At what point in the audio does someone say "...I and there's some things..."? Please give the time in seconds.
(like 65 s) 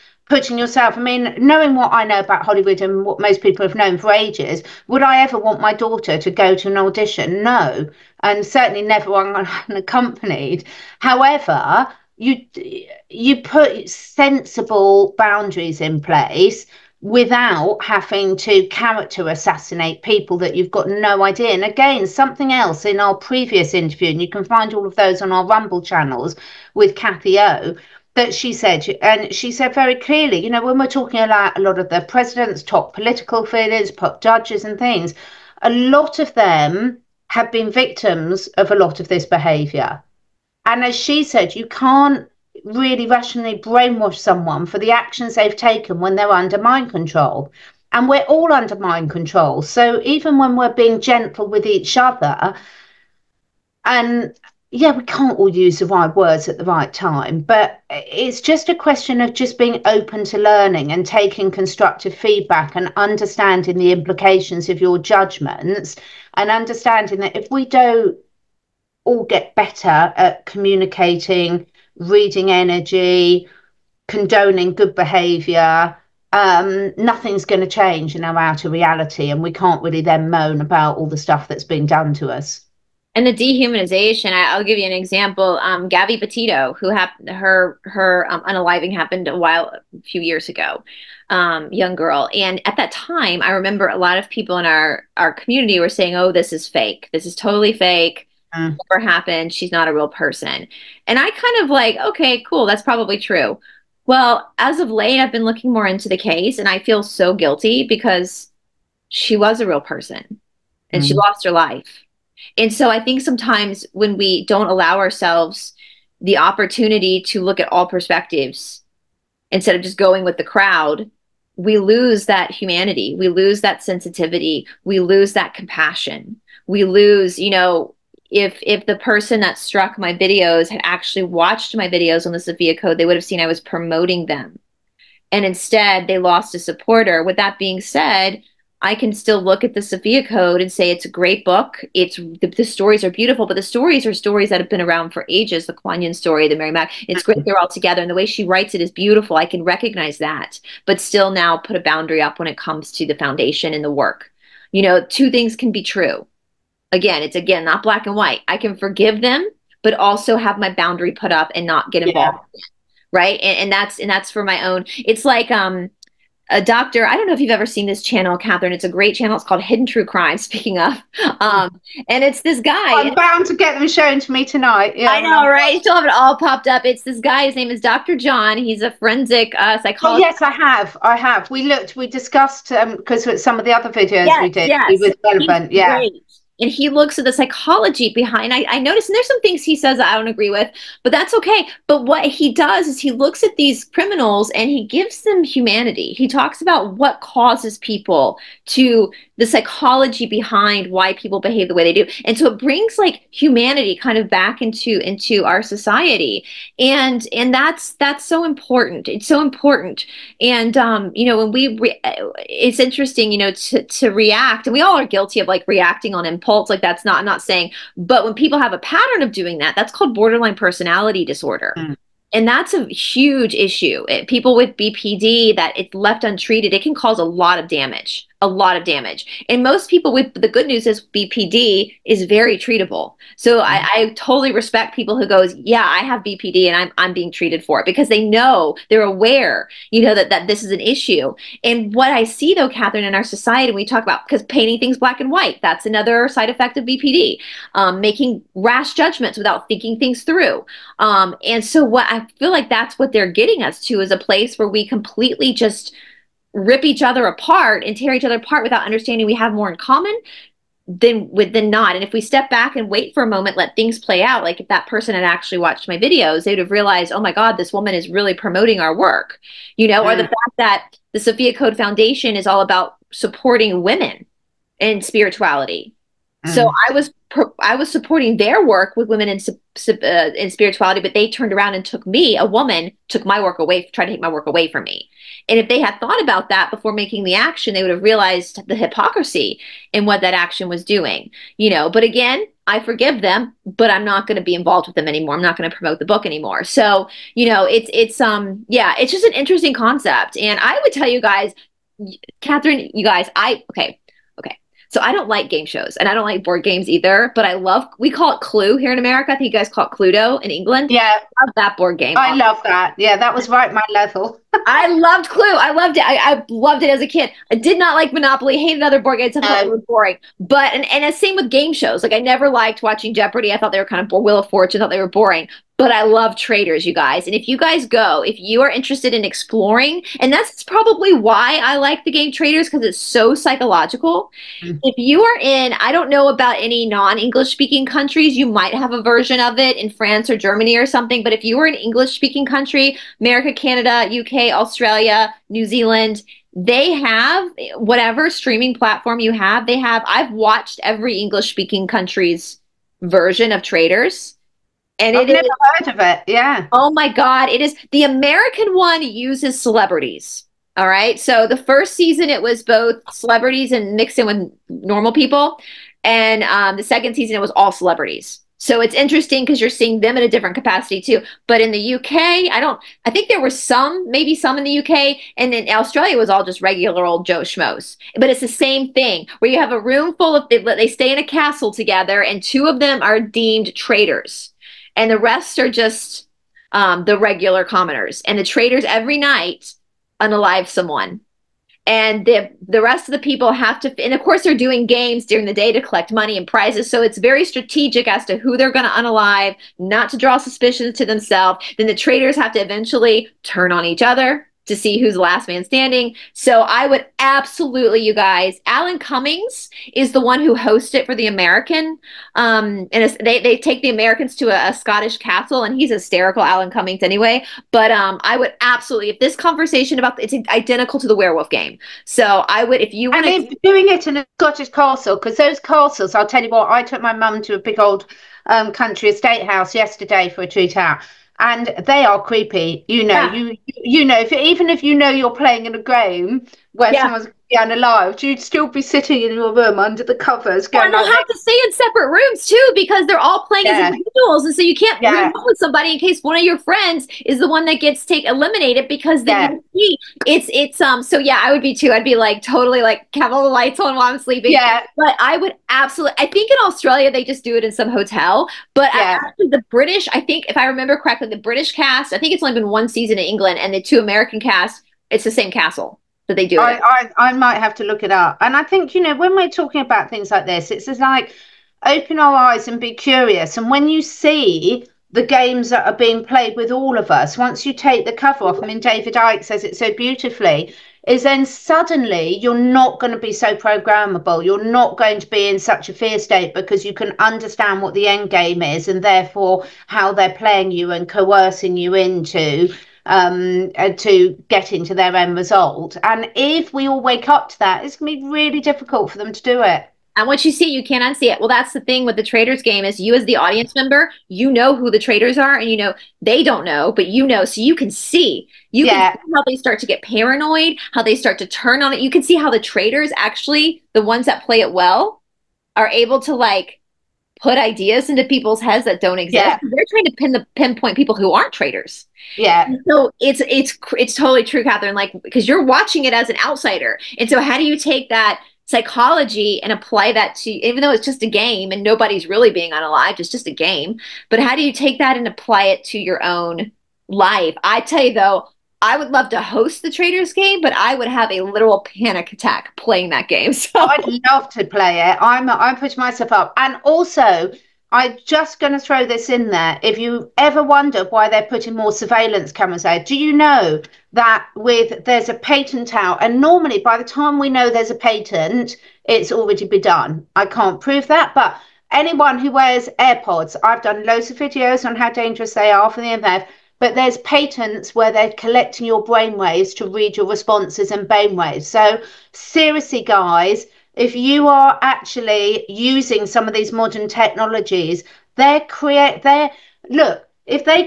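188 s.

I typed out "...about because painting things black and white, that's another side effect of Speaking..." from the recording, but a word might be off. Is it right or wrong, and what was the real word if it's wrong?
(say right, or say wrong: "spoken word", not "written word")
wrong: "BPD", not "Speaking".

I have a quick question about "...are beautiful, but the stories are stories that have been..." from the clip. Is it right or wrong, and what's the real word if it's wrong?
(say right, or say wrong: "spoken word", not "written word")
right.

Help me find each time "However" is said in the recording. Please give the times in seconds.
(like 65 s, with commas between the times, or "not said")
11 s.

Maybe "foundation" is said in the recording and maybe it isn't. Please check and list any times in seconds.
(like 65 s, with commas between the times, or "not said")
153 s, 271 s.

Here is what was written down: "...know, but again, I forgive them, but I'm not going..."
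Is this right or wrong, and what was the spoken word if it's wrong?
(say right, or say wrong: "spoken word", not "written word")
right.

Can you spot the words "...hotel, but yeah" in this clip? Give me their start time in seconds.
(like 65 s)
457 s.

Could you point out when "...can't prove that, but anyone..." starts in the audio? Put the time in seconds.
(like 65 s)
560 s.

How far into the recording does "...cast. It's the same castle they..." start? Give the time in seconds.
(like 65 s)
464 s.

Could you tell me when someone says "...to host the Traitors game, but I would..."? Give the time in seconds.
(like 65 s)
539 s.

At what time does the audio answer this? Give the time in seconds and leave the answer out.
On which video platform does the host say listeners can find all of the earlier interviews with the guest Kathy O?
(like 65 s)
25 s.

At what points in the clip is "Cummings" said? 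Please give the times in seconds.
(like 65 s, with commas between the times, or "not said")
408 s, 416 s.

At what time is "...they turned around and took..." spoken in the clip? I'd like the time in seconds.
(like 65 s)
281 s.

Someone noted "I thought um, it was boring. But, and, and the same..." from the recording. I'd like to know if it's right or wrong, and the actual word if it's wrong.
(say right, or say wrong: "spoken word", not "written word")
right.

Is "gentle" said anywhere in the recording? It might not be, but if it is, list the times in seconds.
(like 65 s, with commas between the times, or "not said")
51 s.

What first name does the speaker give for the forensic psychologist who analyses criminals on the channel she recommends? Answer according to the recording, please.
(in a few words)
Dr. John.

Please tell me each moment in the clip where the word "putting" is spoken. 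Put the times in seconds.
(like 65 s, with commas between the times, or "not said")
0 s, 551 s.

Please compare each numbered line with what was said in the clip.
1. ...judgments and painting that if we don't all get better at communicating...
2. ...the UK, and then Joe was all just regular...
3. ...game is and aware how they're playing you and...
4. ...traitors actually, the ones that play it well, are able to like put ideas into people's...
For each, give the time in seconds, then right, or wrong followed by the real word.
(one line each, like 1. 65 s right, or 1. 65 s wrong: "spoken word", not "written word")
1. 64 s wrong: "understanding", not "painting"
2. 374 s wrong: "Australia", not "Joe"
3. 488 s wrong: "therefore", not "aware"
4. 512 s right.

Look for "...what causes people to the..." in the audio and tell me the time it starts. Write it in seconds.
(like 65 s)
196 s.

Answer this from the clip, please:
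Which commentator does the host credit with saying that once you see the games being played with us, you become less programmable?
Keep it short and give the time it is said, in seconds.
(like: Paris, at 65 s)
David Icke, at 478 s.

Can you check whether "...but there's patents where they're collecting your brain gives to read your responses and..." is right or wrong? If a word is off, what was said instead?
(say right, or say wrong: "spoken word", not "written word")
wrong: "waves", not "gives".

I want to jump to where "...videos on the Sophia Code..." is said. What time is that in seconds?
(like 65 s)
131 s.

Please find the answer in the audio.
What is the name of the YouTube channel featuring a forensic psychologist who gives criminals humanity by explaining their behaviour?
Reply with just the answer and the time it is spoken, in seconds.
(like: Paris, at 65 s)
Hidden True Crime, at 169 s.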